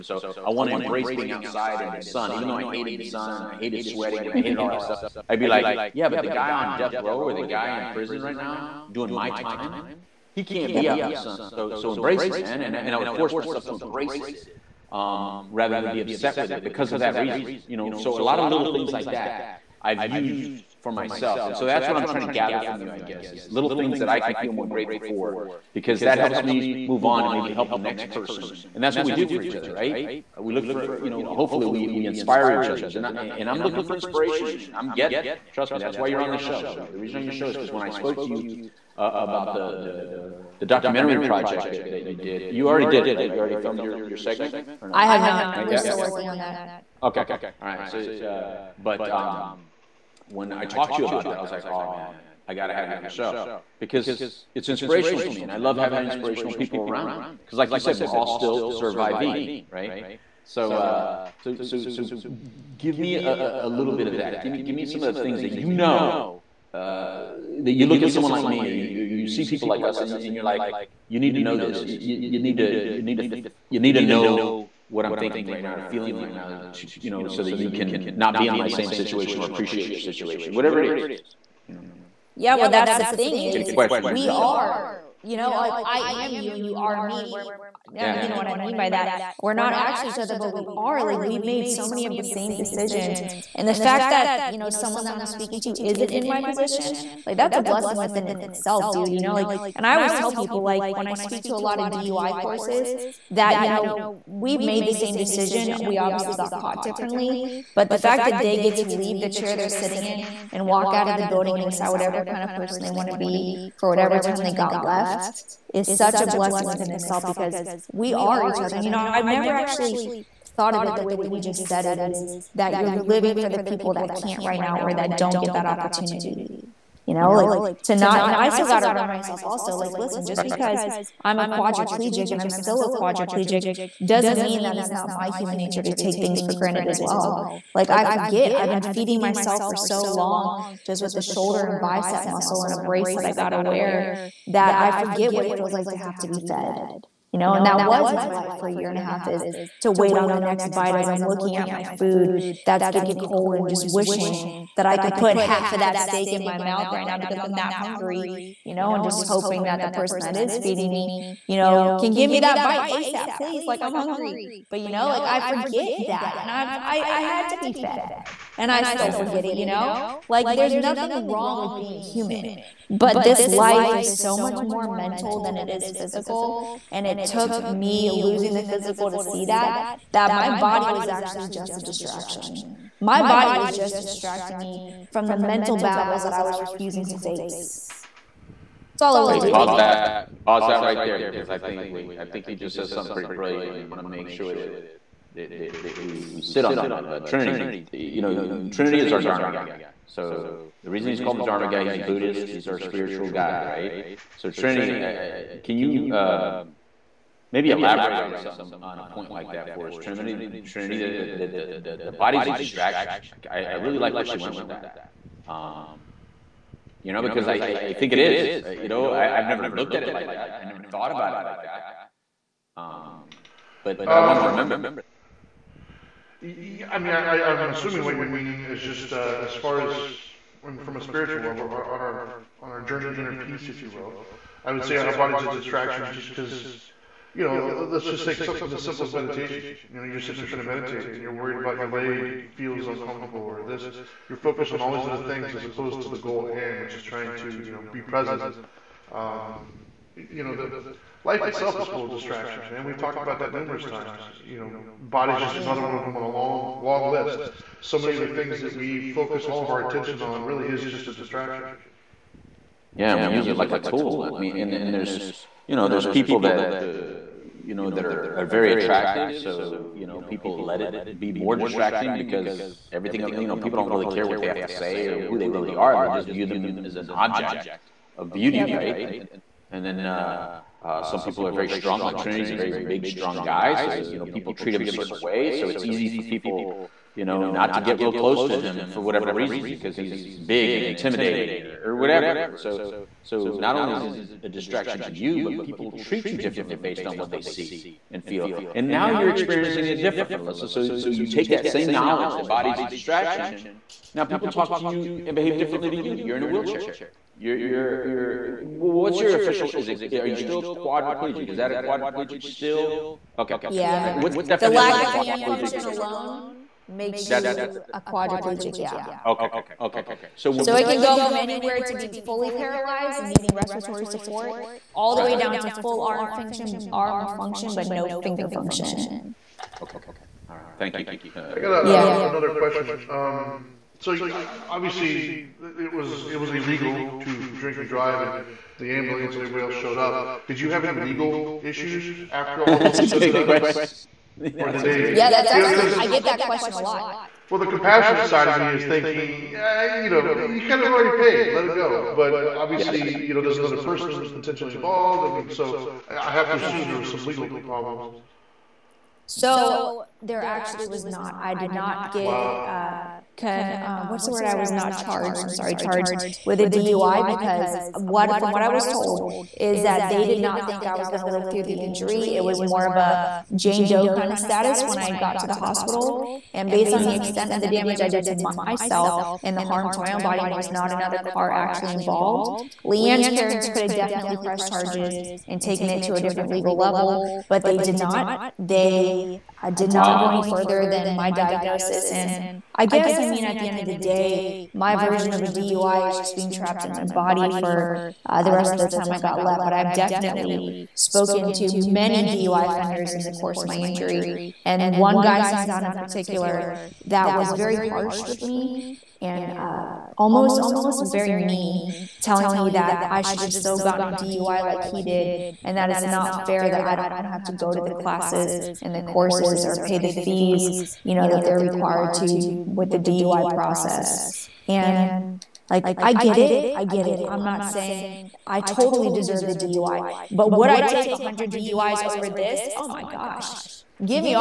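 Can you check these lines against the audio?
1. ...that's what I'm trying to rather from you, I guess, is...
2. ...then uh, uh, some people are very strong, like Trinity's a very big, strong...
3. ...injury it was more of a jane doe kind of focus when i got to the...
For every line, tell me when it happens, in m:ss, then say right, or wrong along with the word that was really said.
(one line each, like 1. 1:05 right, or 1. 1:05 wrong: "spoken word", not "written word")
1. 0:21 wrong: "gather", not "rather"
2. 4:39 right
3. 6:11 wrong: "status", not "focus".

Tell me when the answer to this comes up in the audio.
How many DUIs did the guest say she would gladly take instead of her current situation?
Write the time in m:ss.
7:11.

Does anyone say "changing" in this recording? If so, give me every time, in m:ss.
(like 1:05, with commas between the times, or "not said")
not said.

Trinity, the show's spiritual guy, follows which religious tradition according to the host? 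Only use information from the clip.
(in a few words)
Buddhist.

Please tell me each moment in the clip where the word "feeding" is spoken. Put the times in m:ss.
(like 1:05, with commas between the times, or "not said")
2:18, 2:40.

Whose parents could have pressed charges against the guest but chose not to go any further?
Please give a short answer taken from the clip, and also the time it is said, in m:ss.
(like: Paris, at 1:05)
Leanne's, at 6:22.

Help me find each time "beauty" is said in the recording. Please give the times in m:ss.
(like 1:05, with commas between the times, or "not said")
4:38.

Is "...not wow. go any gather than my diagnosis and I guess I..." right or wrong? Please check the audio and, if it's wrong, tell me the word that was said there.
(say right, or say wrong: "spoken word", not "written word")
wrong: "further", not "gather".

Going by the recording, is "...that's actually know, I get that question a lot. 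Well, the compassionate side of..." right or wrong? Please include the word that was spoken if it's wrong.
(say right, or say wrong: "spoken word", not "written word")
right.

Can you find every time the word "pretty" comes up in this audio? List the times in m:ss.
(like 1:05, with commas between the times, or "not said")
3:13.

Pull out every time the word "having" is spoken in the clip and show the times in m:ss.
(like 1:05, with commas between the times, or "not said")
0:55.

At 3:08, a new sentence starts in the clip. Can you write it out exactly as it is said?
That's all I was Wait, doing.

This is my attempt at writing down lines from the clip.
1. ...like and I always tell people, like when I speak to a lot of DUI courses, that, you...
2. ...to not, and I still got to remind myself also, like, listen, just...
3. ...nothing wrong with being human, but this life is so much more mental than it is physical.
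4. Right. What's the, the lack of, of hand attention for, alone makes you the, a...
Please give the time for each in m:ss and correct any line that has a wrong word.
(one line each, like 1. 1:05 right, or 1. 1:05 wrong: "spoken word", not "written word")
1. 1:39 right
2. 2:07 right
3. 2:50 right
4. 5:14 wrong: "function", not "attention".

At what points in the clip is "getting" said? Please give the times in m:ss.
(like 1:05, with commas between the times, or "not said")
0:34, 2:32.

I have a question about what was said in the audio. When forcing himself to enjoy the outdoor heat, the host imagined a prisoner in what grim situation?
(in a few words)
death row.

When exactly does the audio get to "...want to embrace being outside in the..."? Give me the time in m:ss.
0:00.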